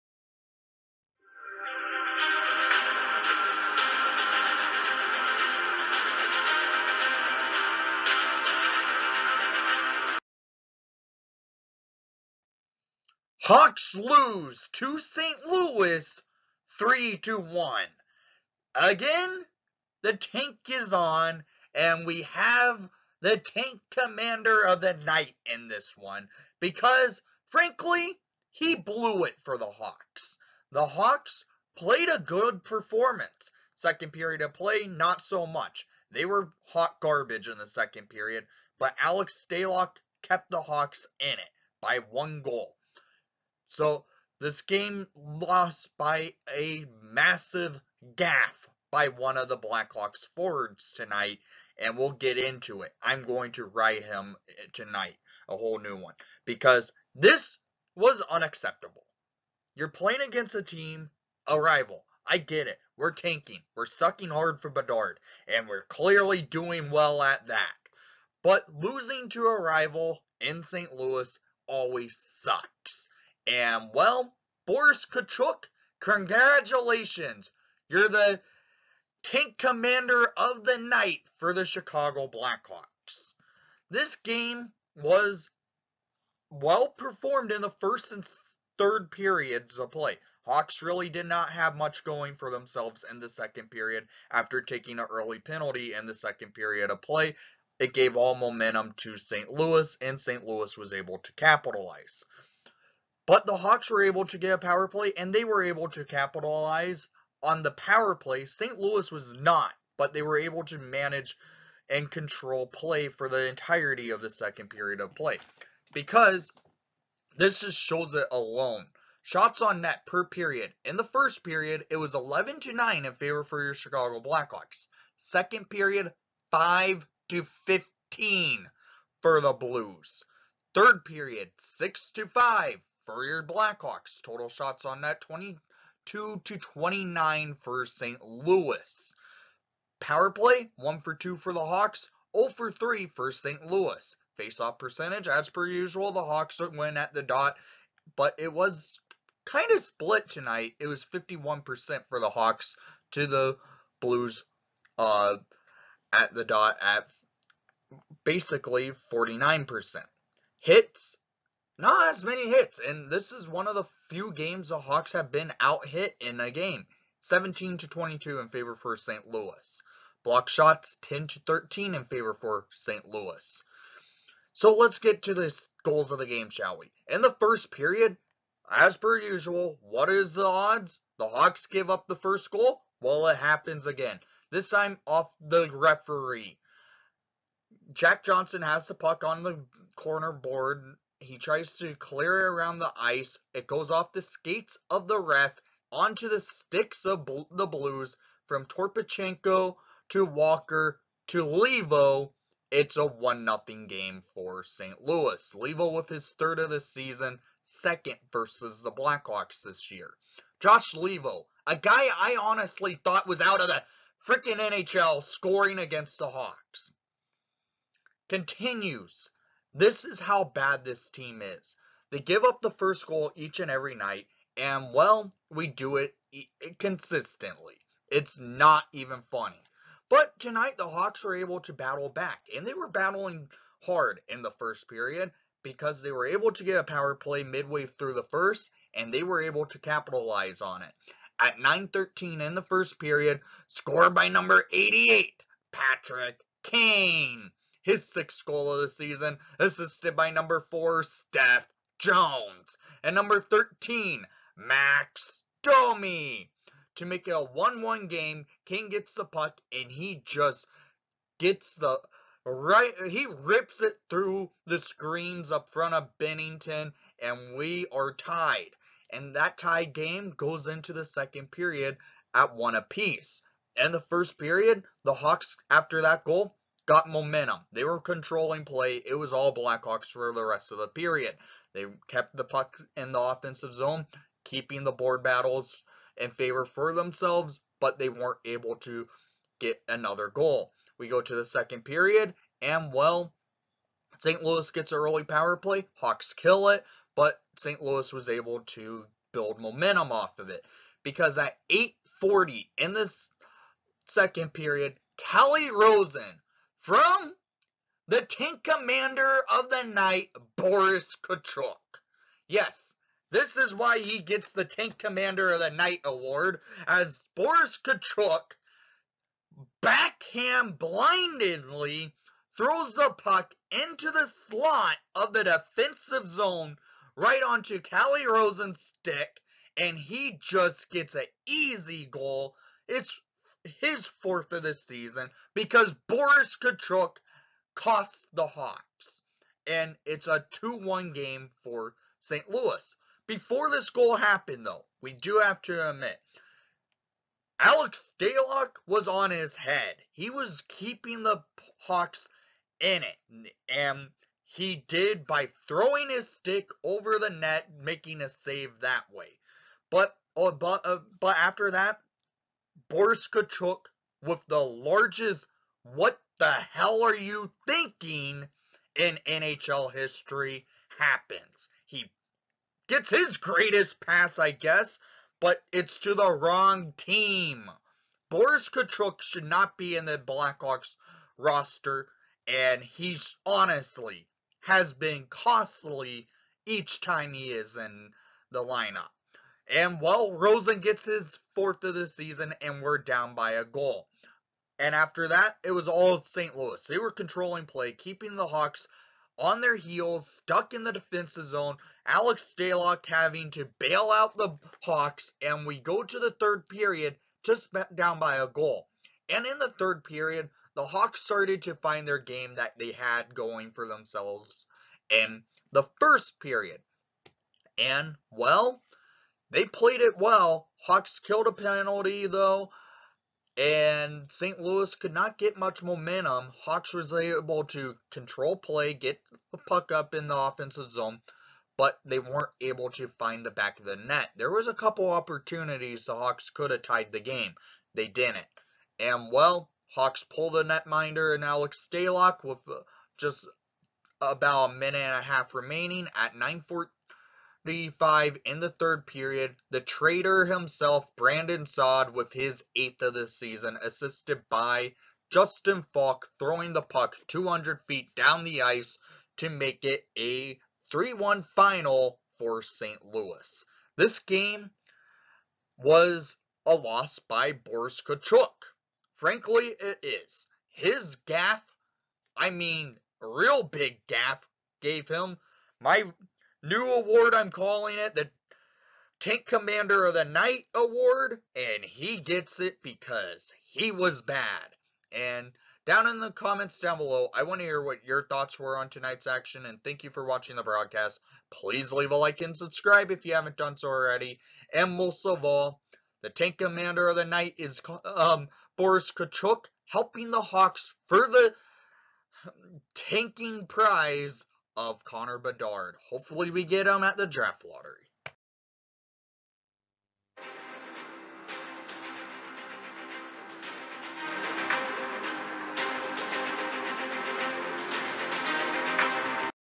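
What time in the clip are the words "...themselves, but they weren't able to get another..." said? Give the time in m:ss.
4:46.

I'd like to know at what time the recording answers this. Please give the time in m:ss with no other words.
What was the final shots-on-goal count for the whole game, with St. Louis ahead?
2:15.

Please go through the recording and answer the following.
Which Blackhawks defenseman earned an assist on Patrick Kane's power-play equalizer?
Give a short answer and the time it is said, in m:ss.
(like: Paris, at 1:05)
Seth Jones, at 4:11.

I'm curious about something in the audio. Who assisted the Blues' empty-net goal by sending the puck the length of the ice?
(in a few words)
Justin Faulk.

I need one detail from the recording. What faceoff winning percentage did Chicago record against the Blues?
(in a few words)
51%.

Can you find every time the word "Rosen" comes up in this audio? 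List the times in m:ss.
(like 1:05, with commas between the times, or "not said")
5:05, 5:28, 6:30.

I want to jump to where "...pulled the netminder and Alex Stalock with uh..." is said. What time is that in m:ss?
7:20.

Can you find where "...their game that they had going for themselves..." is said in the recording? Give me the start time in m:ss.
6:52.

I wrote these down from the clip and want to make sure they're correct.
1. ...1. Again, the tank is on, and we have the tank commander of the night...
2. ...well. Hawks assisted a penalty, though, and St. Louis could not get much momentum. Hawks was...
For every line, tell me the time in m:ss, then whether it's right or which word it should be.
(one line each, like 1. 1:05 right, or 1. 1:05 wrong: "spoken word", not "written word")
1. 0:17 right
2. 7:00 wrong: "killed", not "assisted".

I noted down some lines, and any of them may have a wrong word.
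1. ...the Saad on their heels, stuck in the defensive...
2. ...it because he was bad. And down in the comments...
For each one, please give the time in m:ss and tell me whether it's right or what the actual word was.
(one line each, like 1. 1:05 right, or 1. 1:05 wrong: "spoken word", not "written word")
1. 6:38 wrong: "Hawks", not "Saad"
2. 8:02 right.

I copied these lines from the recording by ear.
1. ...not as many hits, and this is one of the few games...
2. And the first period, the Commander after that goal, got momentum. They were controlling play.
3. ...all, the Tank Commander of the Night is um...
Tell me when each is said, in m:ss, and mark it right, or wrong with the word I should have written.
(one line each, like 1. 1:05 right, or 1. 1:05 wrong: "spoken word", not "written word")
1. 2:41 right
2. 4:33 wrong: "Hawks", not "Commander"
3. 8:15 right.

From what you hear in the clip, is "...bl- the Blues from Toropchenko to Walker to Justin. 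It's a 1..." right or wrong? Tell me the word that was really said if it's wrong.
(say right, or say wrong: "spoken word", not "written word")
wrong: "Leivo", not "Justin".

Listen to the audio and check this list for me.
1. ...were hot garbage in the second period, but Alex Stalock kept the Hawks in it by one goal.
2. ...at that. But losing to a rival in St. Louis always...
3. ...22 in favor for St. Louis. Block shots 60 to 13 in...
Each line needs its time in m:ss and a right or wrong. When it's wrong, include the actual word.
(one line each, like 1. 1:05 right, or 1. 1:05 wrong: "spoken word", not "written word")
1. 0:36 right
2. 1:07 right
3. 2:47 wrong: "10", not "60".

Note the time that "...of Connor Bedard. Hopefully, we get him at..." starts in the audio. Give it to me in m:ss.
8:24.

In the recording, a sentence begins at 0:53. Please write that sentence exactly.
I'm going to write him eh, tonight, a whole new one, because this was unacceptable.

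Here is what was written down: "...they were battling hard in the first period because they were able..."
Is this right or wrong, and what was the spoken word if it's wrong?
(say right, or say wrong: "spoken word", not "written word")
right.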